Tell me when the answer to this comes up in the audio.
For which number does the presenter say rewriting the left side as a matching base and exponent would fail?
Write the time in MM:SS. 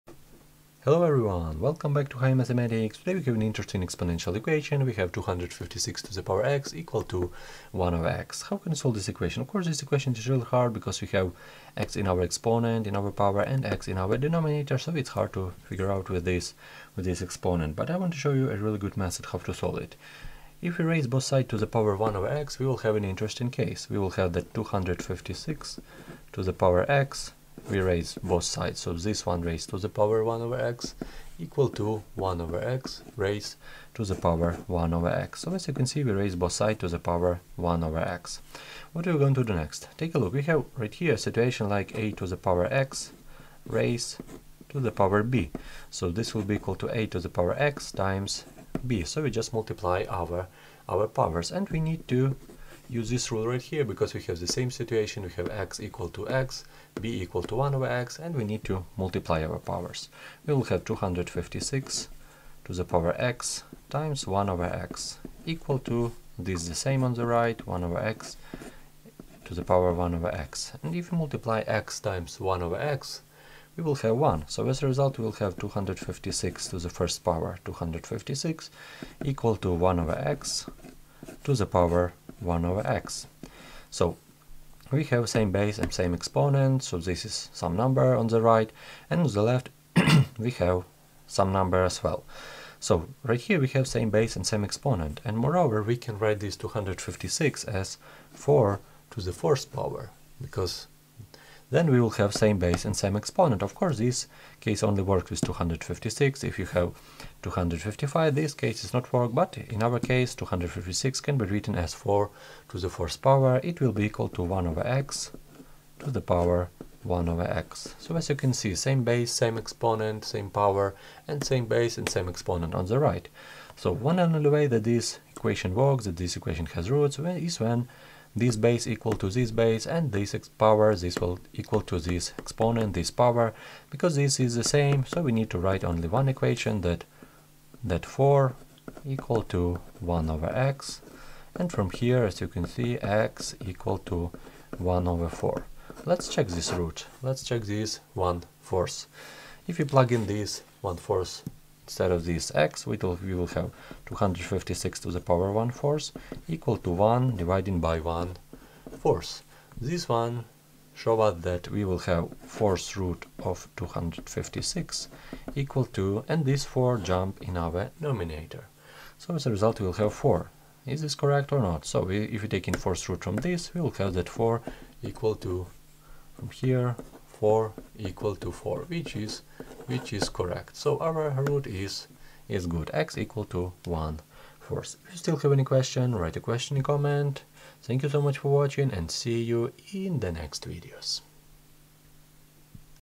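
01:47.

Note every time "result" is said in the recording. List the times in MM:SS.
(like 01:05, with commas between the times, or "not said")
01:14, 02:49.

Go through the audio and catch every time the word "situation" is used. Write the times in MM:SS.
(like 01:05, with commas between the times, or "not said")
00:41, 00:54.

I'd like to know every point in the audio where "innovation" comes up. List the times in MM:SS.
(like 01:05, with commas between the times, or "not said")
not said.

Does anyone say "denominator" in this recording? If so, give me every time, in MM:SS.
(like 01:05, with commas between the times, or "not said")
00:14, 02:47.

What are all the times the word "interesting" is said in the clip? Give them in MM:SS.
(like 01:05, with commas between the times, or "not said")
00:03, 00:23.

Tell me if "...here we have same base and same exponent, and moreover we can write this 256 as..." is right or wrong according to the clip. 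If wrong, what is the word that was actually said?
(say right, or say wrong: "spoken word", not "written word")
right.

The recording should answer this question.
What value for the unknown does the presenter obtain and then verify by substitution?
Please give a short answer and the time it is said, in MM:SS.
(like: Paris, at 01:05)
1/4, at 02:24.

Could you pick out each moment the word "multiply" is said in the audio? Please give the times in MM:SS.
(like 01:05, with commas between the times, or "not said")
00:49, 00:58, 01:11.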